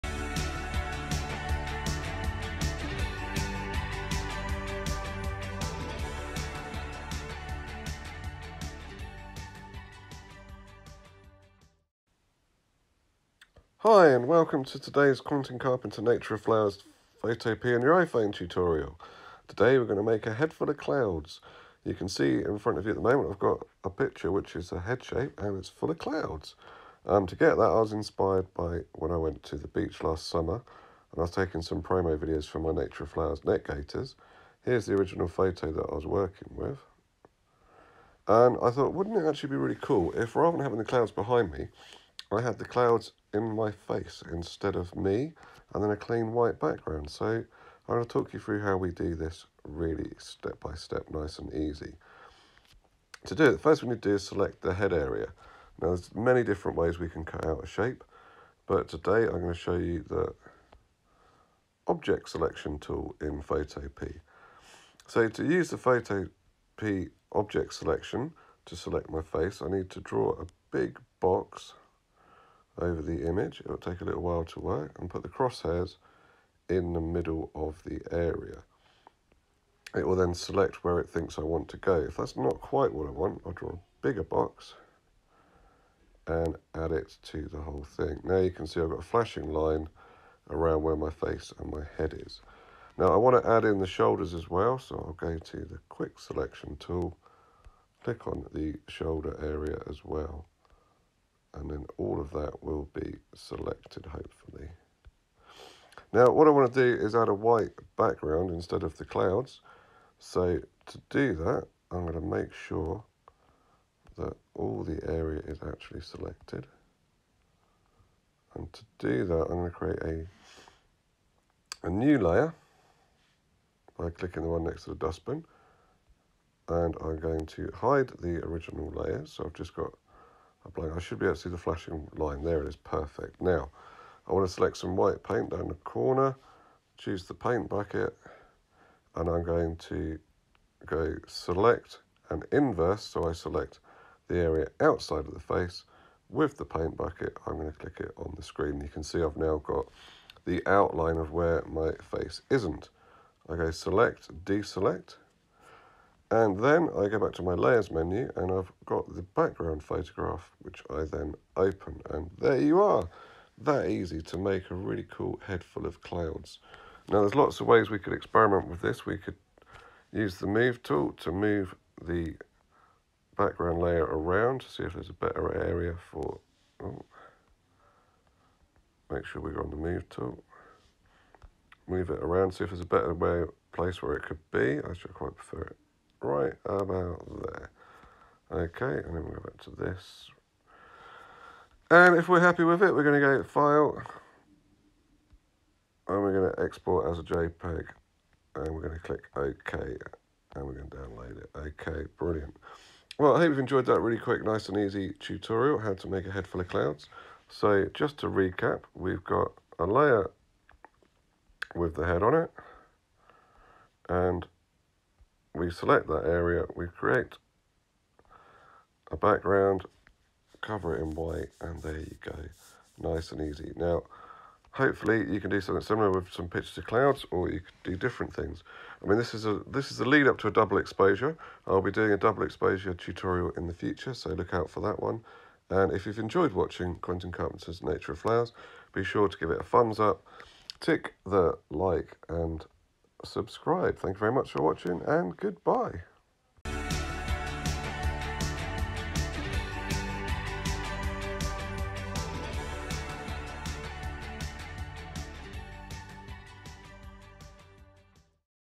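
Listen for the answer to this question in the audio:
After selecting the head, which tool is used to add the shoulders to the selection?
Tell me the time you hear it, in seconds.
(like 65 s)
95 s.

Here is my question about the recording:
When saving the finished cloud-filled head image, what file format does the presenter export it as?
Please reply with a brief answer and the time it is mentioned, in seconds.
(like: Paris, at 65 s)
JPEG, at 197 s.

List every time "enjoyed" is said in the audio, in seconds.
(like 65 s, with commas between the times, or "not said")
203 s, 236 s.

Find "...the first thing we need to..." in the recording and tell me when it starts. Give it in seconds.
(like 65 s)
53 s.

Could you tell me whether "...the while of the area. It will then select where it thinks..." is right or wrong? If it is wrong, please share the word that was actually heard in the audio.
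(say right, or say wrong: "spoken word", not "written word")
wrong: "middle", not "while".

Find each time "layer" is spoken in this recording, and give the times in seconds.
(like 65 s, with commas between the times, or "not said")
122 s, 128 s, 157 s, 173 s, 209 s.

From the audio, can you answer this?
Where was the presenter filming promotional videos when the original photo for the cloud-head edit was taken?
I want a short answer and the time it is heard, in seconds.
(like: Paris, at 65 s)
The beach, at 29 s.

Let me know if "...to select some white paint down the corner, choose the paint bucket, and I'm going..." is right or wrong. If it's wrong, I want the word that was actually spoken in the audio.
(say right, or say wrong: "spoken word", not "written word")
right.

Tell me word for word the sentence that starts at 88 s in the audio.
Now you can see I've got a flashing line around where my face and my head is.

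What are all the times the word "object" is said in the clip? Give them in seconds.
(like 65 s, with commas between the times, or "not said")
61 s, 67 s.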